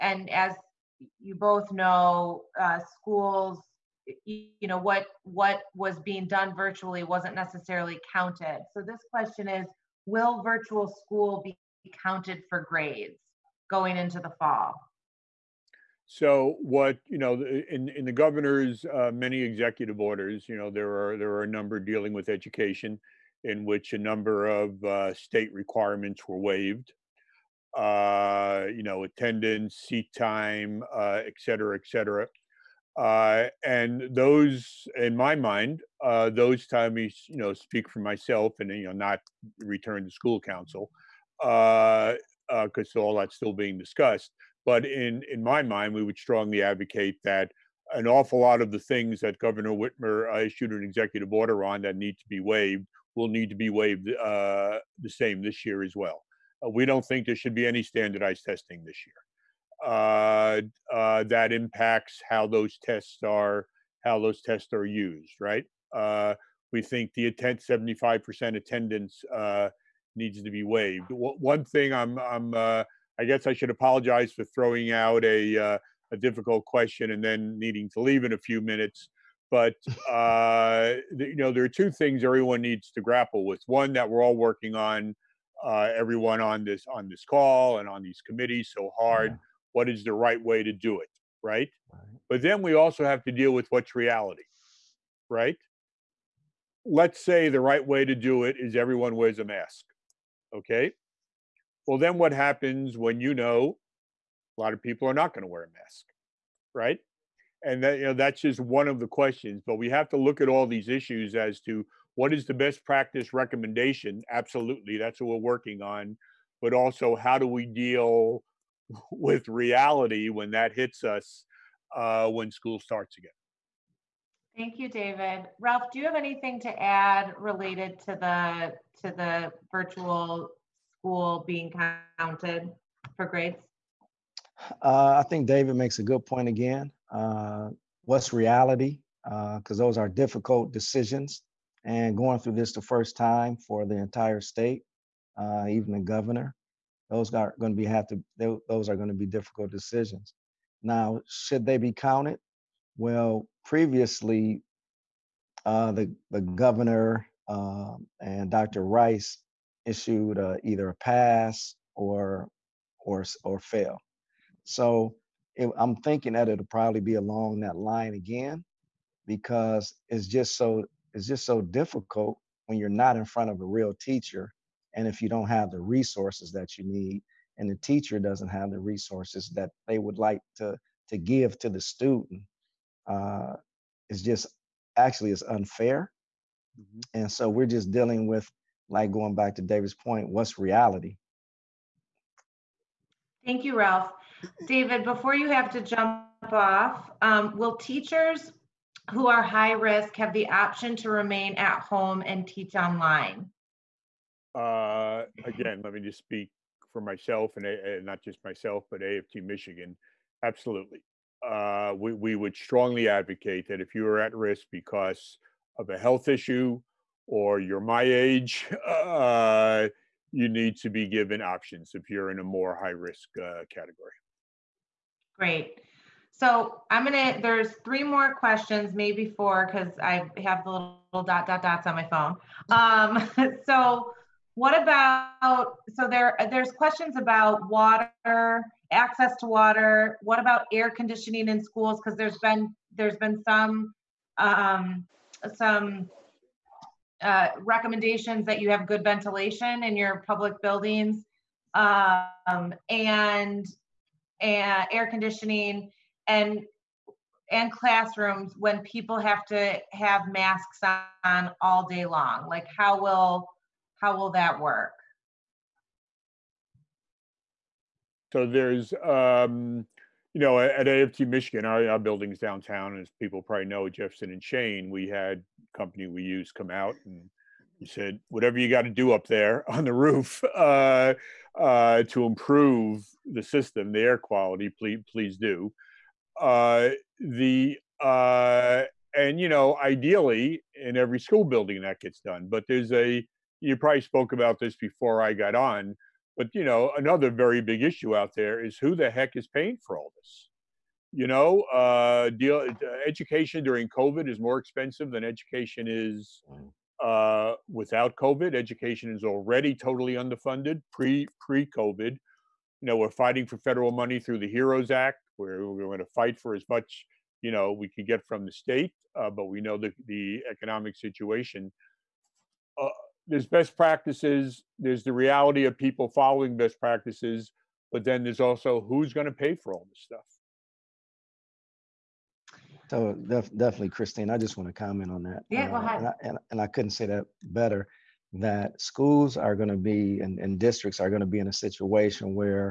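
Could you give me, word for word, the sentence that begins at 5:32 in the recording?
So def- definitely, Christine, I just want to comment on that.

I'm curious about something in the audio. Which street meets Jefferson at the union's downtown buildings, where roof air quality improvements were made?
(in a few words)
Chene.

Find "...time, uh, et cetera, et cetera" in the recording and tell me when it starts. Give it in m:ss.
0:30.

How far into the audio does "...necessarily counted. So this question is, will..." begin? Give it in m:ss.
0:07.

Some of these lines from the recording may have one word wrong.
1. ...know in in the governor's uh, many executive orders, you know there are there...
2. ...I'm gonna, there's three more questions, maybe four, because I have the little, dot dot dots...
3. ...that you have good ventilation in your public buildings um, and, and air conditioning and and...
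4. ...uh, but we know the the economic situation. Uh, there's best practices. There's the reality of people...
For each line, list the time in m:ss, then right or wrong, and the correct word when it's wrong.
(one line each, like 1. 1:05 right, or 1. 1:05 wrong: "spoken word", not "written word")
1. 0:17 right
2. 3:46 right
3. 4:08 right
4. 5:19 right.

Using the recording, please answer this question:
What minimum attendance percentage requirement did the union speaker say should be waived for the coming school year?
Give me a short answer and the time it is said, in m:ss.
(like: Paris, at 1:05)
75%, at 1:07.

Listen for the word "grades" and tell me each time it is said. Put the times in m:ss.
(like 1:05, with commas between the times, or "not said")
0:12, 2:13.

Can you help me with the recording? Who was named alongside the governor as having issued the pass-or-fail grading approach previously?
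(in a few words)
Dr. Rice.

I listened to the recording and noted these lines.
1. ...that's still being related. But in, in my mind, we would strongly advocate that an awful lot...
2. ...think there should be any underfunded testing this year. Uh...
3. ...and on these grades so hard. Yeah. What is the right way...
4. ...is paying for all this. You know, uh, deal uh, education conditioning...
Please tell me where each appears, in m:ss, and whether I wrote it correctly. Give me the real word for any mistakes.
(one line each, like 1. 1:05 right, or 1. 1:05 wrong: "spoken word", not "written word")
1. 0:43 wrong: "discussed", not "related"
2. 0:57 wrong: "standardized", not "underfunded"
3. 1:27 wrong: "committees", not "grades"
4. 4:59 wrong: "during", not "conditioning".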